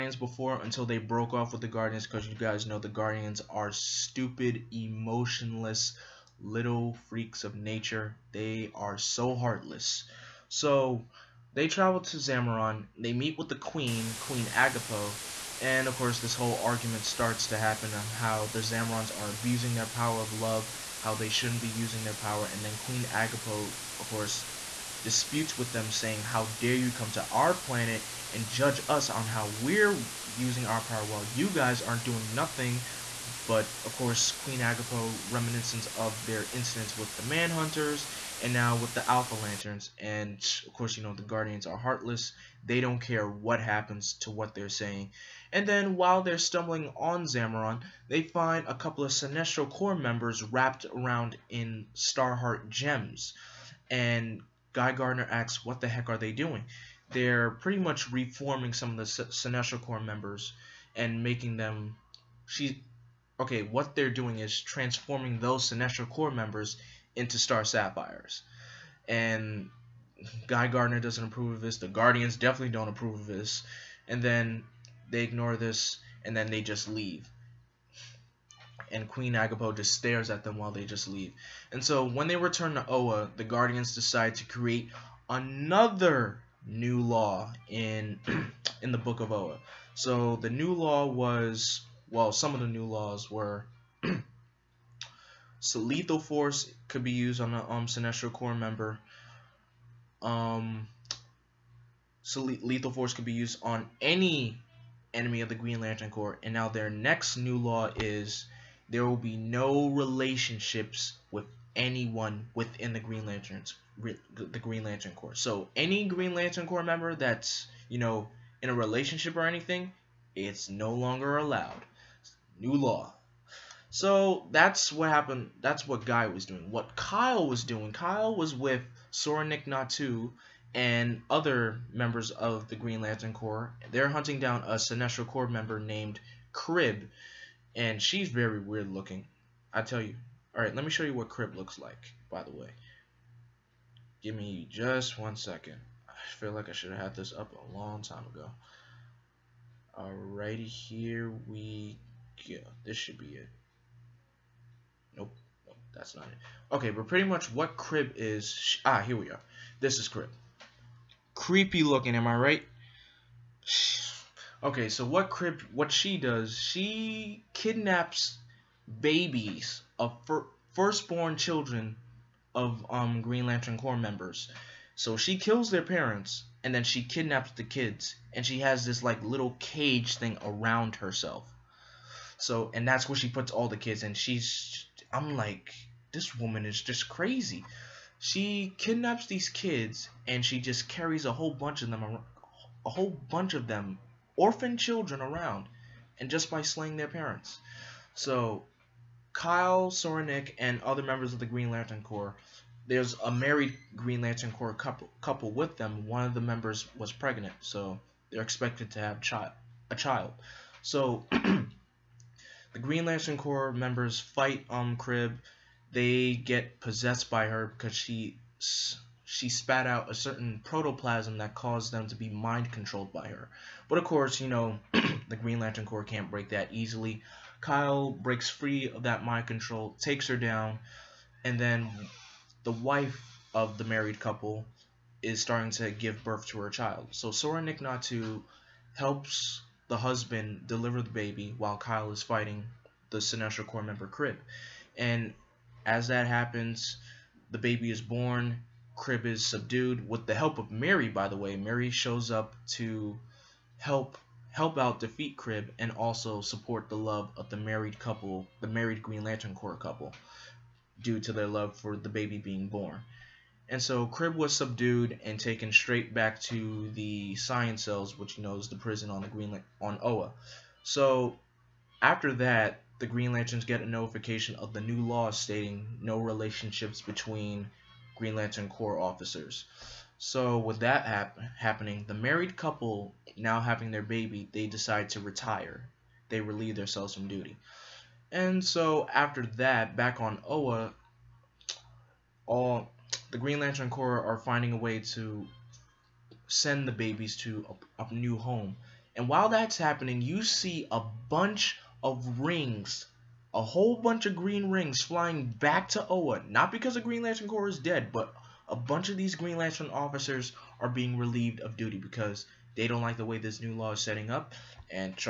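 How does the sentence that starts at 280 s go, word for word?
So with that hap happening, the married couple now having their baby, they decide to retire.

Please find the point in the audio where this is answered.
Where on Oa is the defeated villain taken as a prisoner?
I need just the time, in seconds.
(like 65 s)
266 s.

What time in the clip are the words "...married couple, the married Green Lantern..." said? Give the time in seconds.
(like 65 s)
257 s.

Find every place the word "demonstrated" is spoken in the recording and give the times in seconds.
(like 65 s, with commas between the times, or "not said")
not said.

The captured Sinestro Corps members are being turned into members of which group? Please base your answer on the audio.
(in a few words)
Star Sapphires.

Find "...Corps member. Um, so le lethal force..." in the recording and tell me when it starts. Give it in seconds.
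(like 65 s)
98 s.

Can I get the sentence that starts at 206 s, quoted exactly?
One of the members was pregnant, so they're expected to have chi- a child.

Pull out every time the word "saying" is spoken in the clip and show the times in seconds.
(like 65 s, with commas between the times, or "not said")
25 s, 44 s.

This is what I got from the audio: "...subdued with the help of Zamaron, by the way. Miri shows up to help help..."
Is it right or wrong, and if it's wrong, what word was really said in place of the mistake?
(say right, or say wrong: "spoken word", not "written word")
wrong: "Miri", not "Zamaron".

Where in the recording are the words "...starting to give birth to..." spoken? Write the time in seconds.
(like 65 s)
235 s.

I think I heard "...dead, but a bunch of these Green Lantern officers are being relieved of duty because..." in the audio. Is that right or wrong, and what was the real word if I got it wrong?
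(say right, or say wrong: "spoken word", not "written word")
right.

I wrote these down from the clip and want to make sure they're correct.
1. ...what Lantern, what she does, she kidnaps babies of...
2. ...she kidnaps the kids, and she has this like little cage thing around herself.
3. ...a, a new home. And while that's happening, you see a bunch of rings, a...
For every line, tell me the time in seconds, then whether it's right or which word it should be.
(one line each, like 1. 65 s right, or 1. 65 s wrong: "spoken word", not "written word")
1. 165 s wrong: "Kryb", not "Lantern"
2. 176 s right
3. 297 s right.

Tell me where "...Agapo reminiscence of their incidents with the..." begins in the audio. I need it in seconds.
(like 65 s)
34 s.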